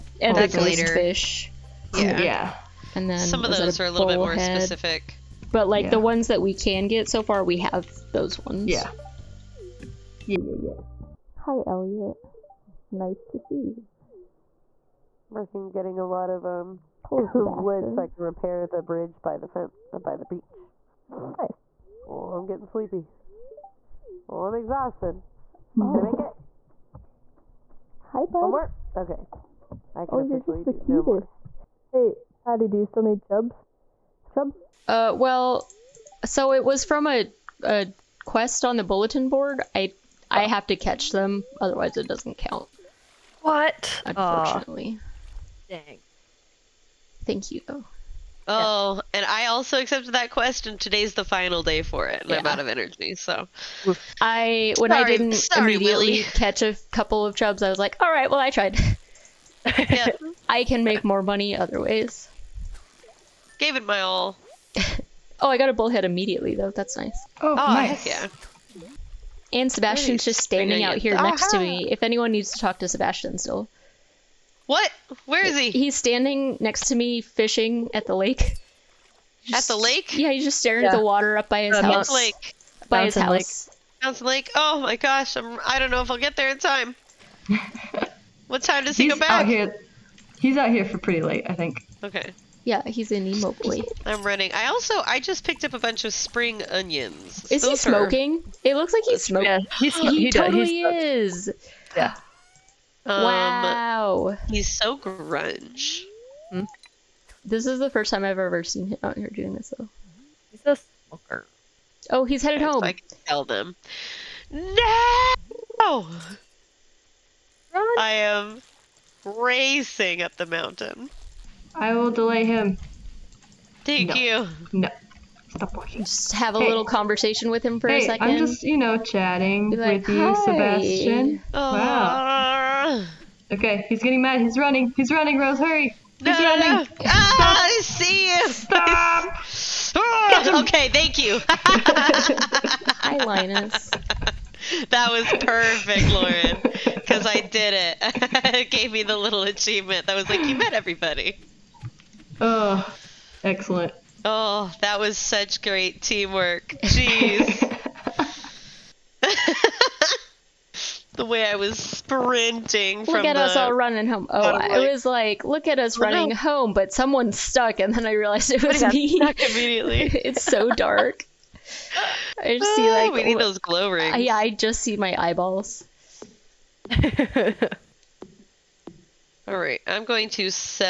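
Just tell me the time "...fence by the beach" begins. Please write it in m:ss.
0:19.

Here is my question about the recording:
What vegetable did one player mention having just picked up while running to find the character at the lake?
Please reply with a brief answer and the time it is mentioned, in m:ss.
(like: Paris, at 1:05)
spring onions, at 1:36.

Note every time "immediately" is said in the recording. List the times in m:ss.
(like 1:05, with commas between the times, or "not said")
0:55, 1:06, 2:49.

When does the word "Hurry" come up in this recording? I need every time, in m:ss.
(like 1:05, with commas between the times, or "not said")
2:15.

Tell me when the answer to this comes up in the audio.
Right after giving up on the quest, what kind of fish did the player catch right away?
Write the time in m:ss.
1:05.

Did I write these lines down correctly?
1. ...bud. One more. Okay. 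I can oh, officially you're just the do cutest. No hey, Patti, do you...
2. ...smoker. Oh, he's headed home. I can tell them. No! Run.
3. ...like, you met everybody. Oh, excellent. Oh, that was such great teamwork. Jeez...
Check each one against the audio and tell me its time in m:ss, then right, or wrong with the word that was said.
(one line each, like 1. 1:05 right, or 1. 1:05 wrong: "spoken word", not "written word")
1. 0:28 right
2. 1:51 right
3. 2:30 right.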